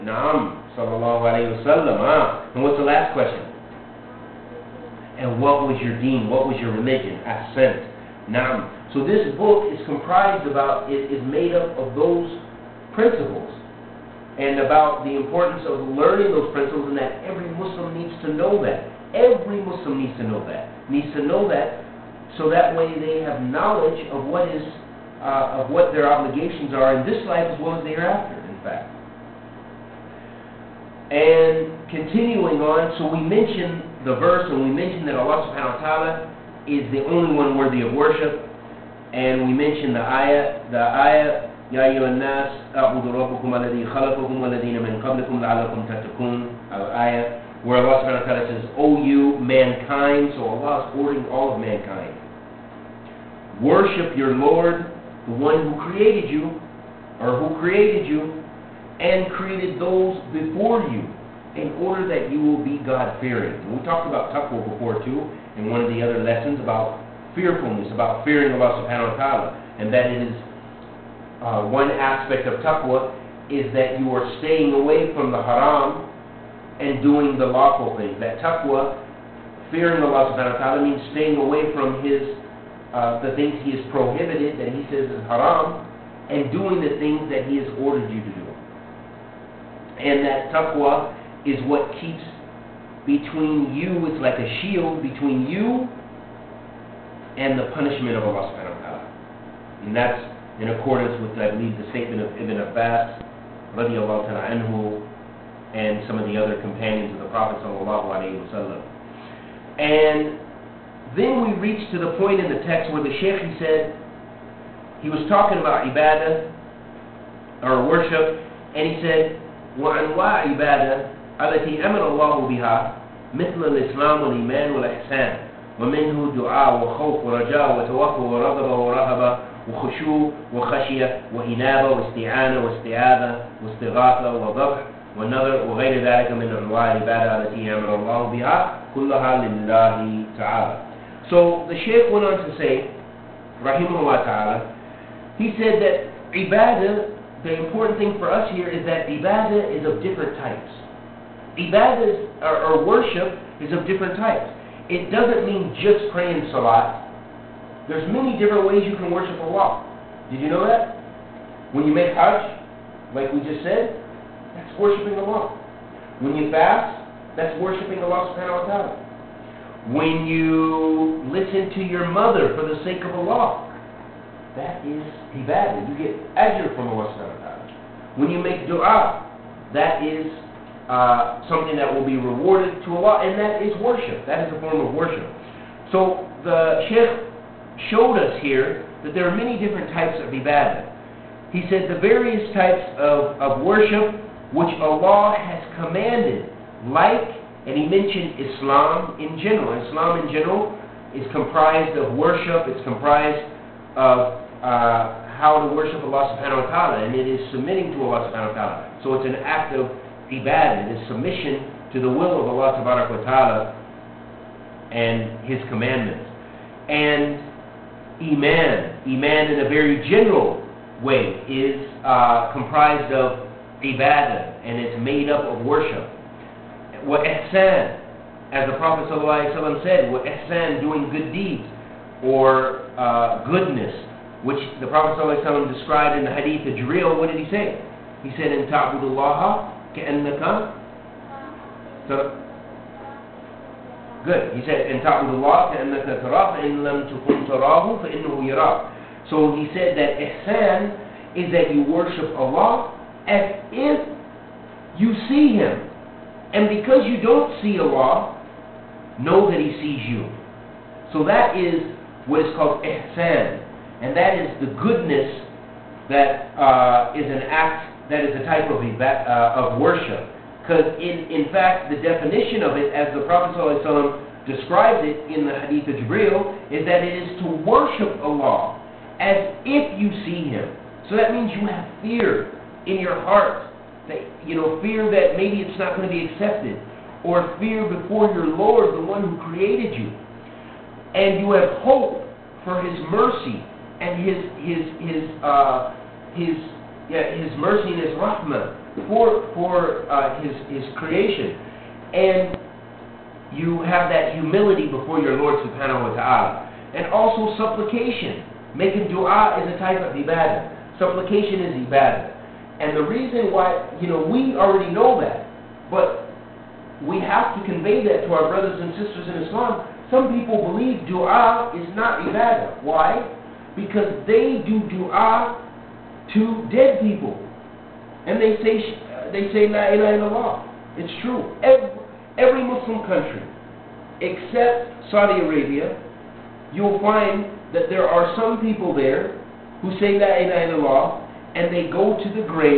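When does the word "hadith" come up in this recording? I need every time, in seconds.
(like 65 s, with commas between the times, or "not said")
236 s, 275 s.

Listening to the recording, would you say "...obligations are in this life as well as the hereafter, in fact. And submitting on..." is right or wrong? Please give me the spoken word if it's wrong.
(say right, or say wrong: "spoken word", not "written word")
wrong: "continuing", not "submitting".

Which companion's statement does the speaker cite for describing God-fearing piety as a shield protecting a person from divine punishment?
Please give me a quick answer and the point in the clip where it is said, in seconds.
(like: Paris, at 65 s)
Ibn Abbas, at 102 s.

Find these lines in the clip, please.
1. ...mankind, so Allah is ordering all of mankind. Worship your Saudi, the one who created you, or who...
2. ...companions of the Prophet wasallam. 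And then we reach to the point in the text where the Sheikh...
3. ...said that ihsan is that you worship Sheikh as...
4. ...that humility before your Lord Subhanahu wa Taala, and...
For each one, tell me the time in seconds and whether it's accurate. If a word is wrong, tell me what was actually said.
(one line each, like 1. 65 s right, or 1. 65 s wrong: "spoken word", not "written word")
1. 49 s wrong: "Lord", not "Saudi"
2. 106 s right
3. 249 s wrong: "Allah", not "Sheikh"
4. 304 s right.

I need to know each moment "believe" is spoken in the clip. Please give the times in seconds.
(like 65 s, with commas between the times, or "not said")
101 s, 320 s.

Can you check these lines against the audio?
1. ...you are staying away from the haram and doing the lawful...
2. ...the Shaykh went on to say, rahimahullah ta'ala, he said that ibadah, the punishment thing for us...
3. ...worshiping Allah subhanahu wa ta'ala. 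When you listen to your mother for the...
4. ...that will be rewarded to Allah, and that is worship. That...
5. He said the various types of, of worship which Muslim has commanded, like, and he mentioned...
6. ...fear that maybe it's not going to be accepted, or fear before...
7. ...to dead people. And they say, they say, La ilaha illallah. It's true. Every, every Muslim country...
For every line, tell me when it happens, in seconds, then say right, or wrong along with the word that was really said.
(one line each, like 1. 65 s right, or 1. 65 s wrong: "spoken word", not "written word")
1. 73 s right
2. 141 s wrong: "important", not "punishment"
3. 167 s right
4. 181 s right
5. 191 s wrong: "Allah", not "Muslim"
6. 284 s right
7. 326 s right.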